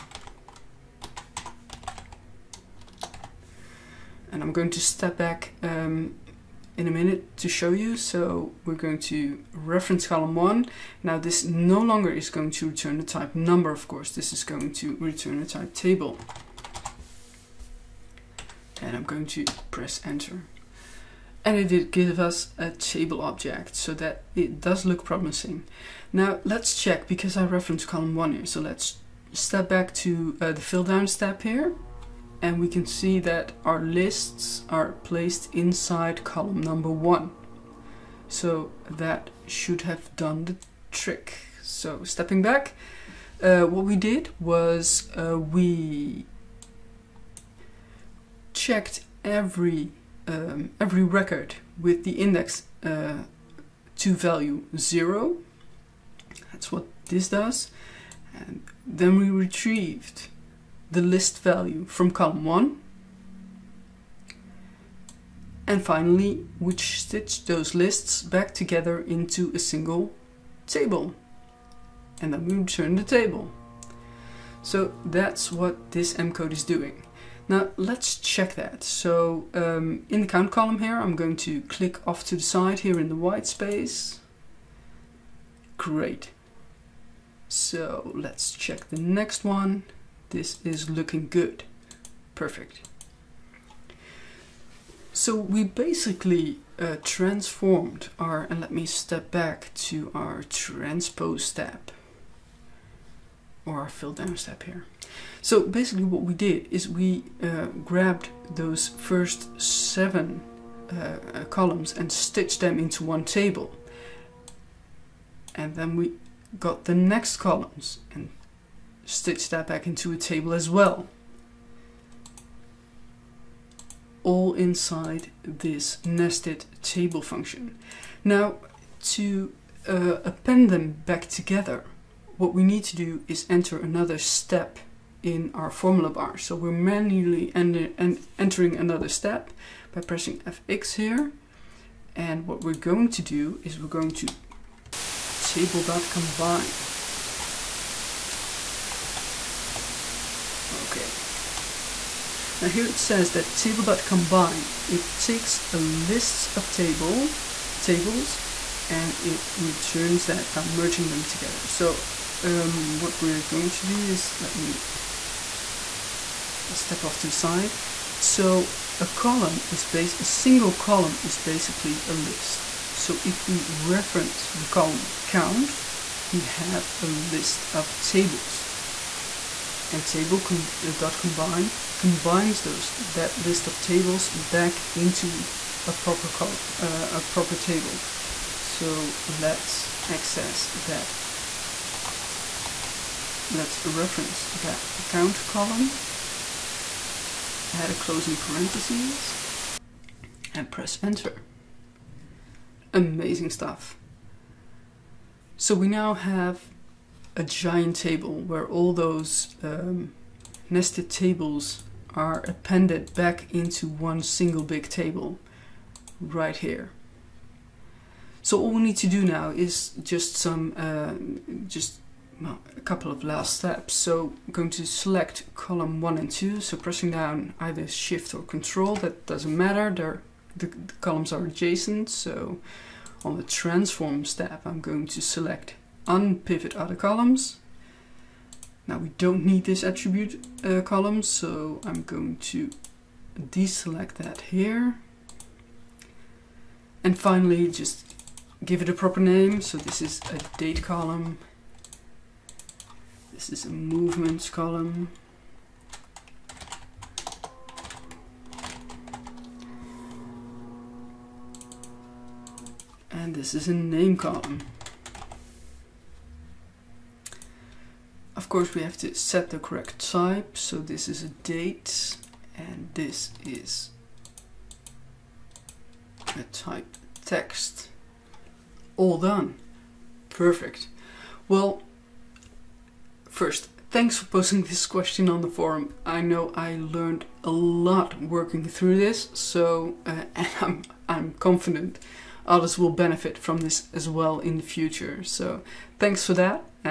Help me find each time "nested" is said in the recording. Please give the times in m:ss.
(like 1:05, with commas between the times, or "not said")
2:06, 3:30.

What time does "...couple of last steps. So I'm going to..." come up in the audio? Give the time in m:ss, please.
3:42.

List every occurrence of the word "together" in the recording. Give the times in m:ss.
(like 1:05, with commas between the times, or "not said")
1:08, 2:11, 2:41.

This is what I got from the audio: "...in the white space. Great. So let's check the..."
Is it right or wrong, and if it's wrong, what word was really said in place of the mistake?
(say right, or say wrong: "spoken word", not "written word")
right.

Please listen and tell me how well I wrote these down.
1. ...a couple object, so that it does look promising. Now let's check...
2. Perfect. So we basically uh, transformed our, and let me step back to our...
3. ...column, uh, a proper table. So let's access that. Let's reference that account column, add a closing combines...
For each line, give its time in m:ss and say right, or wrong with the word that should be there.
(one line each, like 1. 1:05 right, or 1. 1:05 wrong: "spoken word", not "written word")
1. 0:22 wrong: "table", not "couple"
2. 1:32 right
3. 3:06 wrong: "parentheses", not "combines".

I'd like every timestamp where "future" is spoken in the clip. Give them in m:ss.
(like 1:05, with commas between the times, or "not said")
4:54.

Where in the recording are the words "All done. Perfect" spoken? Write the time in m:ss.
4:38.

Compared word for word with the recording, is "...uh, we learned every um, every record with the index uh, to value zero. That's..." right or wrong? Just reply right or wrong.
wrong.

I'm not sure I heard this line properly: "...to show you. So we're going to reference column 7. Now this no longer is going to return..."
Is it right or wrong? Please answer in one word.
wrong.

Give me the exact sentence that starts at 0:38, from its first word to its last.
So that should have done the trick.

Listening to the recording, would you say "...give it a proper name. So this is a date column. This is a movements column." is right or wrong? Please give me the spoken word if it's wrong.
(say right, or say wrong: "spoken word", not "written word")
right.